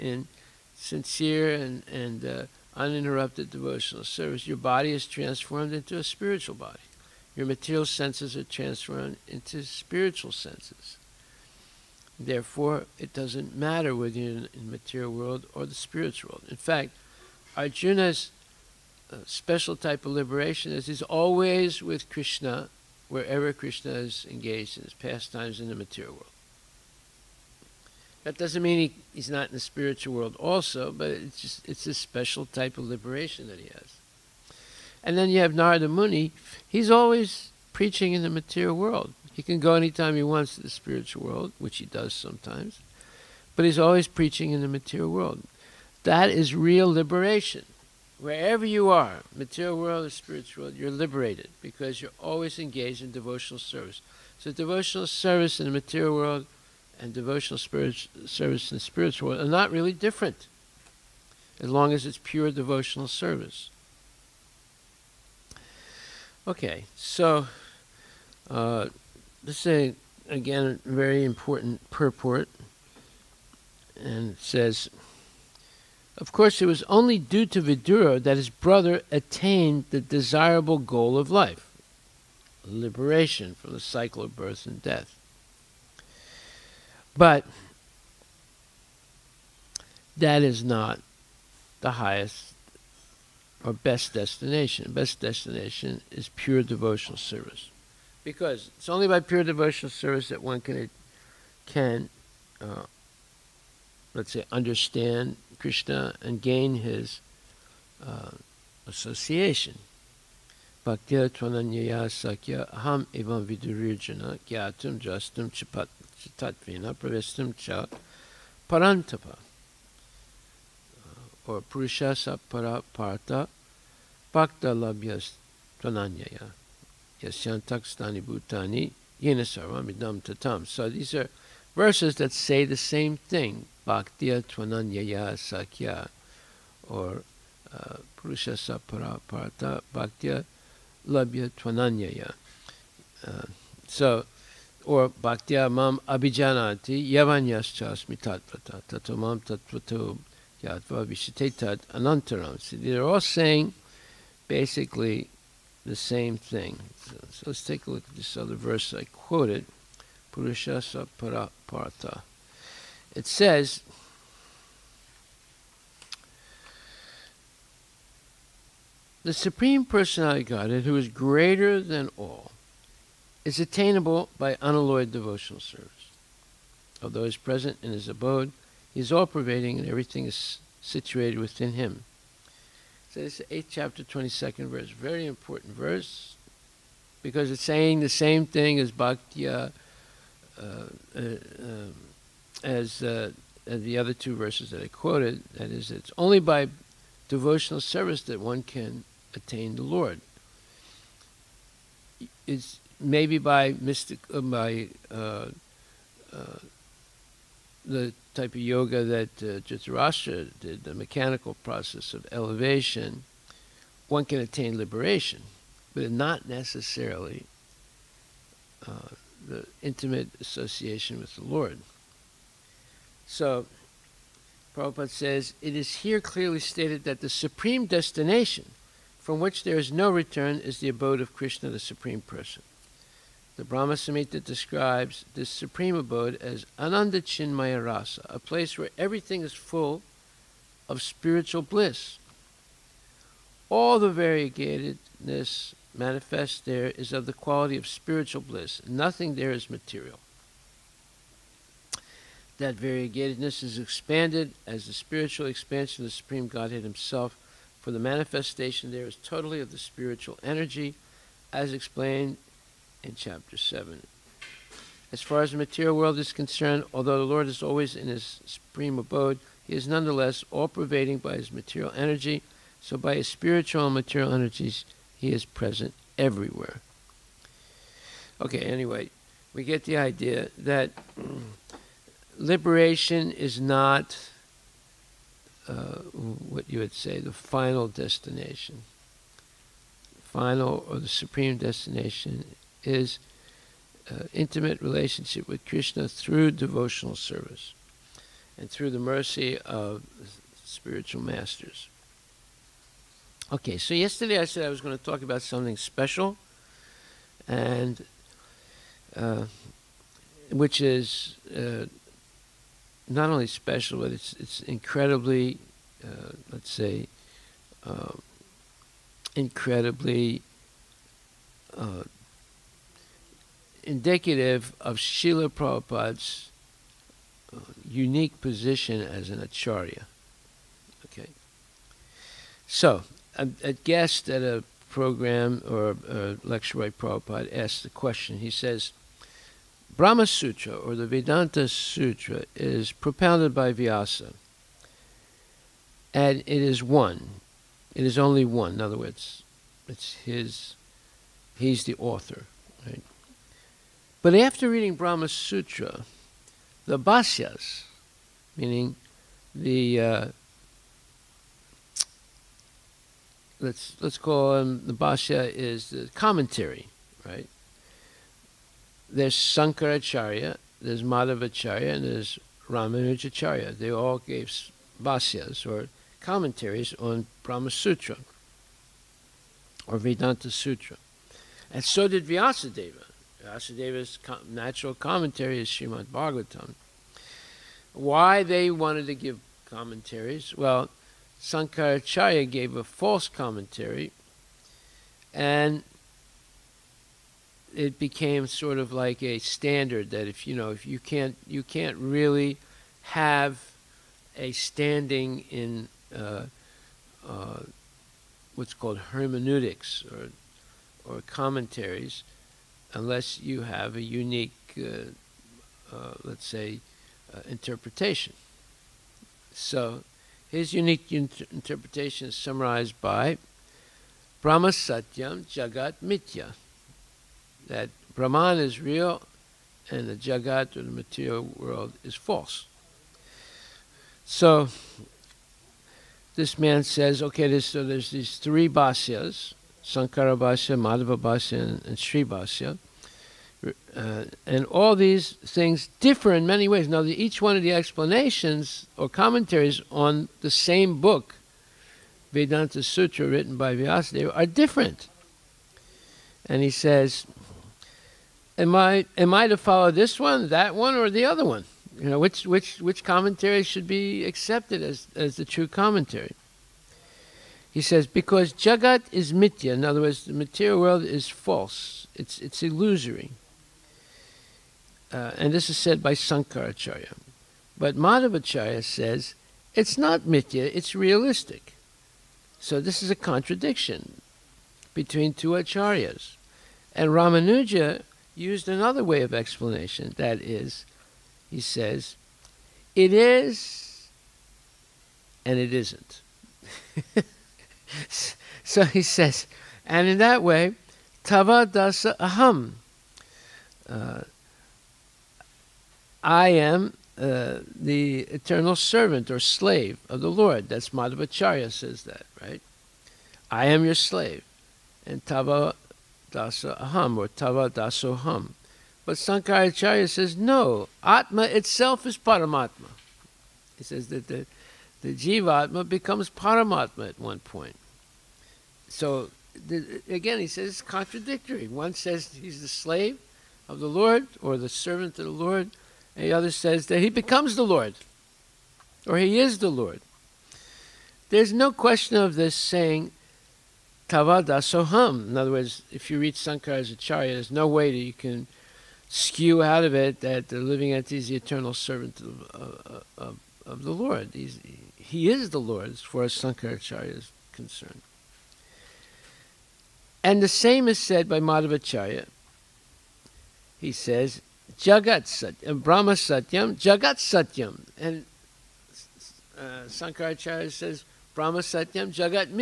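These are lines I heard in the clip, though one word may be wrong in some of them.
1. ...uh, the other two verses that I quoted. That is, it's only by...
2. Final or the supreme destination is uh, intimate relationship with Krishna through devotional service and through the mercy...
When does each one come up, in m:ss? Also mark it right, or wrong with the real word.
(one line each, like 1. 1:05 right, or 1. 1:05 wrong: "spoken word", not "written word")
1. 3:13 right
2. 4:50 right.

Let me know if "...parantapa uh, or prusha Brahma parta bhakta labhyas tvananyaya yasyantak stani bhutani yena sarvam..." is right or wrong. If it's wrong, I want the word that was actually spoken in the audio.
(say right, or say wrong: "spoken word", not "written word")
wrong: "Sapara", not "Brahma".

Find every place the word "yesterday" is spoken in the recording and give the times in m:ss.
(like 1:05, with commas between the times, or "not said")
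5:03.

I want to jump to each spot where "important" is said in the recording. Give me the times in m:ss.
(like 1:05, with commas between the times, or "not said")
1:11, 3:05.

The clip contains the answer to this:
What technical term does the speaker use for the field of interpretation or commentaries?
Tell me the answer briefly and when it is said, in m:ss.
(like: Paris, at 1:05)
hermeneutics, at 6:49.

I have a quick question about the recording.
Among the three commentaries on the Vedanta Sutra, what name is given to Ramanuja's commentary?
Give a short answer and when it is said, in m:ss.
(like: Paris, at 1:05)
Sri Basya, at 7:21.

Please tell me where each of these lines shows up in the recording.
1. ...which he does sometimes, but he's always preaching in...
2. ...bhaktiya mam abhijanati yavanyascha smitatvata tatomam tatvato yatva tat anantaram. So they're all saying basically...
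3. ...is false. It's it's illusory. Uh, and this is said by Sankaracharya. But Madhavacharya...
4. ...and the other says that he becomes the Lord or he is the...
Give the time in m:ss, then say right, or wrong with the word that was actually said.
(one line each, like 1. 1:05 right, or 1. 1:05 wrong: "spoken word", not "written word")
1. 0:41 right
2. 2:25 right
3. 7:51 right
4. 8:56 right.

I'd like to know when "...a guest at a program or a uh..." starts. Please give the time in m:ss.
5:33.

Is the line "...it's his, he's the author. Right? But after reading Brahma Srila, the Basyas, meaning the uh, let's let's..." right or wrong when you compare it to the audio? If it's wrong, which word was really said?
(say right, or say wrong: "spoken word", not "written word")
wrong: "Sutra", not "Srila".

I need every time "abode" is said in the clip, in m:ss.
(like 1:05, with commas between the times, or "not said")
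2:58, 3:50, 3:55, 4:28.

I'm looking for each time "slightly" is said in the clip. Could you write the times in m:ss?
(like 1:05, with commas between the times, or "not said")
not said.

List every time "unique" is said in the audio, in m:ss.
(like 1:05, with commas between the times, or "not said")
5:27, 6:54, 7:00.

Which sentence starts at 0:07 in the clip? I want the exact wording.
Your material senses are transformed into spiritual senses.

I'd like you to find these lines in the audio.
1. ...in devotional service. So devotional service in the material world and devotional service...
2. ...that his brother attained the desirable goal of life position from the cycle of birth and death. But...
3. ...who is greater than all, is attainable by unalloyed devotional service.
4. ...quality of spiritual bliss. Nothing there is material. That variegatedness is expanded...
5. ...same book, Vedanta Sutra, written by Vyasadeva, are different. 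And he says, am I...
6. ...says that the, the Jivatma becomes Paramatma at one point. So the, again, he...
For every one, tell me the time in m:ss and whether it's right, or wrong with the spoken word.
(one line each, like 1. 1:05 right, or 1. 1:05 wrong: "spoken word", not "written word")
1. 0:53 right
2. 1:18 wrong: "liberation", not "position"
3. 2:50 right
4. 4:07 right
5. 7:30 right
6. 8:43 right.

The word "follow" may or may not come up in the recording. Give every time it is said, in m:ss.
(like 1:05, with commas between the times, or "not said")
7:39.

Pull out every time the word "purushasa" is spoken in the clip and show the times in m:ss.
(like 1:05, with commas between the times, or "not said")
2:18, 2:40.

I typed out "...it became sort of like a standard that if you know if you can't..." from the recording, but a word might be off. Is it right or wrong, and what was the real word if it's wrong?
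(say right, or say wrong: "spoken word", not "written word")
right.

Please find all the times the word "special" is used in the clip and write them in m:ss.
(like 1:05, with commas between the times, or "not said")
0:19, 0:31, 5:05, 5:13.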